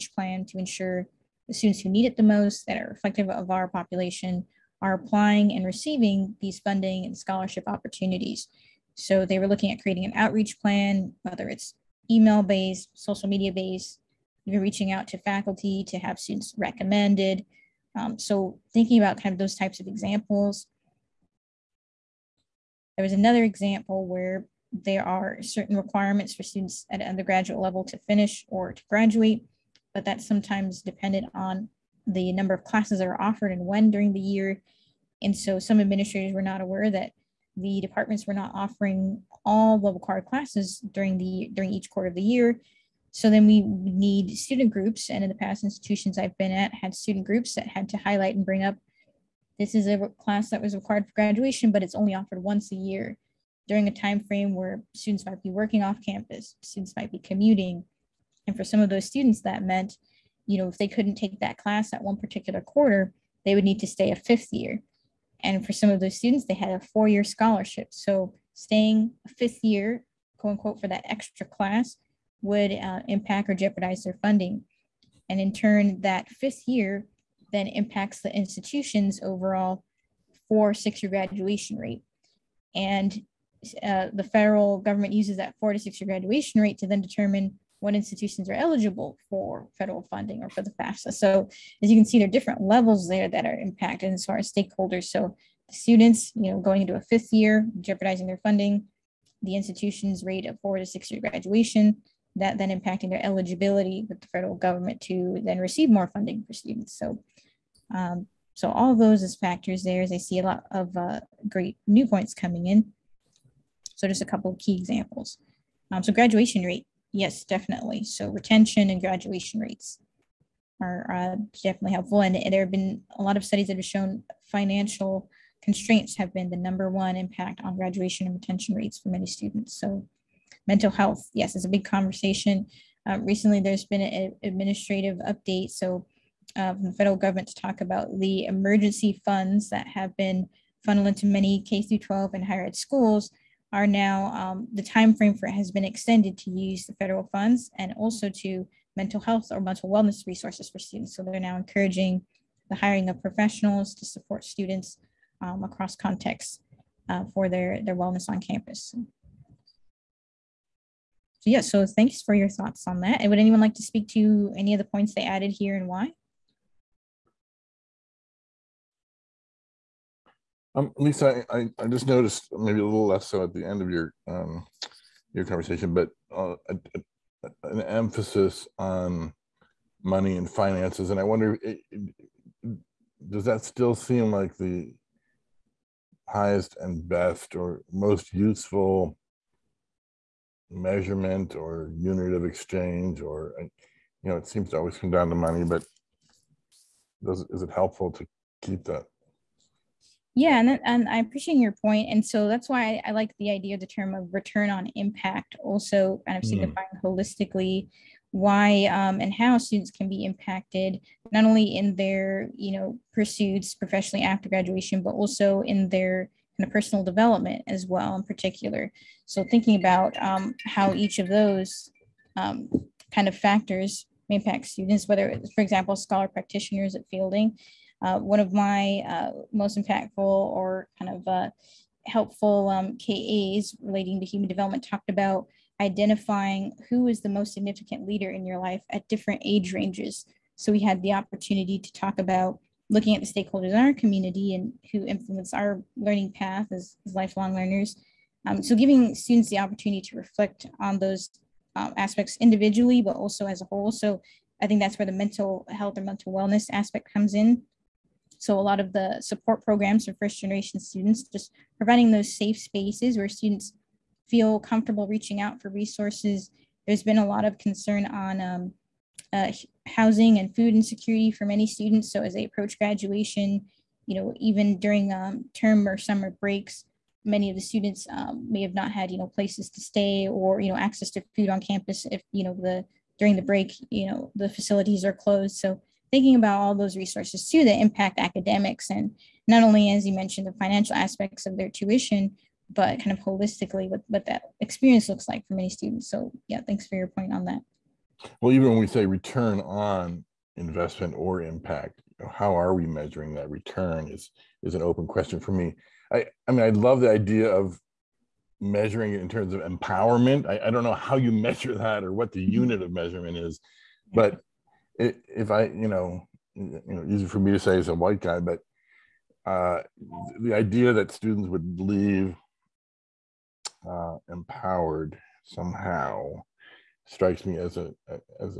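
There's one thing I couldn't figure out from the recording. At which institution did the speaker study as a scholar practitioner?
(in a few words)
Fielding.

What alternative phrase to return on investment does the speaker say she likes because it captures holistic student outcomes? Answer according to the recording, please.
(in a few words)
return on impact.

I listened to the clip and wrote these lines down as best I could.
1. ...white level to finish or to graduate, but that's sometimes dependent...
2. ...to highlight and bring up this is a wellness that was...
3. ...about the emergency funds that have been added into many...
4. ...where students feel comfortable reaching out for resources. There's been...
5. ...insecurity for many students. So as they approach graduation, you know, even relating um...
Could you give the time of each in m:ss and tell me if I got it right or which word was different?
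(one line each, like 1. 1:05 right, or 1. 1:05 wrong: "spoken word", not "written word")
1. 0:27 wrong: "undergraduate", not "white"
2. 0:47 wrong: "class", not "wellness"
3. 2:17 wrong: "funneled", not "added"
4. 4:23 right
5. 4:30 wrong: "during", not "relating".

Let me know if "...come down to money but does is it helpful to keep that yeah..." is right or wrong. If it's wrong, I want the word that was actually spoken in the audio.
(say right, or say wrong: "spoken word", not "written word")
right.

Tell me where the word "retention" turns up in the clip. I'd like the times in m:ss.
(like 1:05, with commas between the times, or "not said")
1:58, 2:08.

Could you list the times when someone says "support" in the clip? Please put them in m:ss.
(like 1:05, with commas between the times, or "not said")
2:34, 4:19.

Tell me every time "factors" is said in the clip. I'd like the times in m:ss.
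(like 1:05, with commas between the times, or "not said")
1:49, 3:43.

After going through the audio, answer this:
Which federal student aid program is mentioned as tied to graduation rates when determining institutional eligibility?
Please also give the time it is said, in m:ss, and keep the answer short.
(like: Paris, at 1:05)
FAFSA, at 1:30.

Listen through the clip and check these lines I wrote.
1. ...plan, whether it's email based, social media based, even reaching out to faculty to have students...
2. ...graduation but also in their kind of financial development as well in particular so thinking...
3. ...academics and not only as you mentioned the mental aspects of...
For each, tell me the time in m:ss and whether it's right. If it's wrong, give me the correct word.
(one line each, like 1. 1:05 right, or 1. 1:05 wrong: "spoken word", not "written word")
1. 0:10 right
2. 3:34 wrong: "personal", not "financial"
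3. 4:48 wrong: "financial", not "mental".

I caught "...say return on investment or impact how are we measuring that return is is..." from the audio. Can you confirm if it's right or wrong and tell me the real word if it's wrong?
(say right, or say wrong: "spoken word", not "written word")
right.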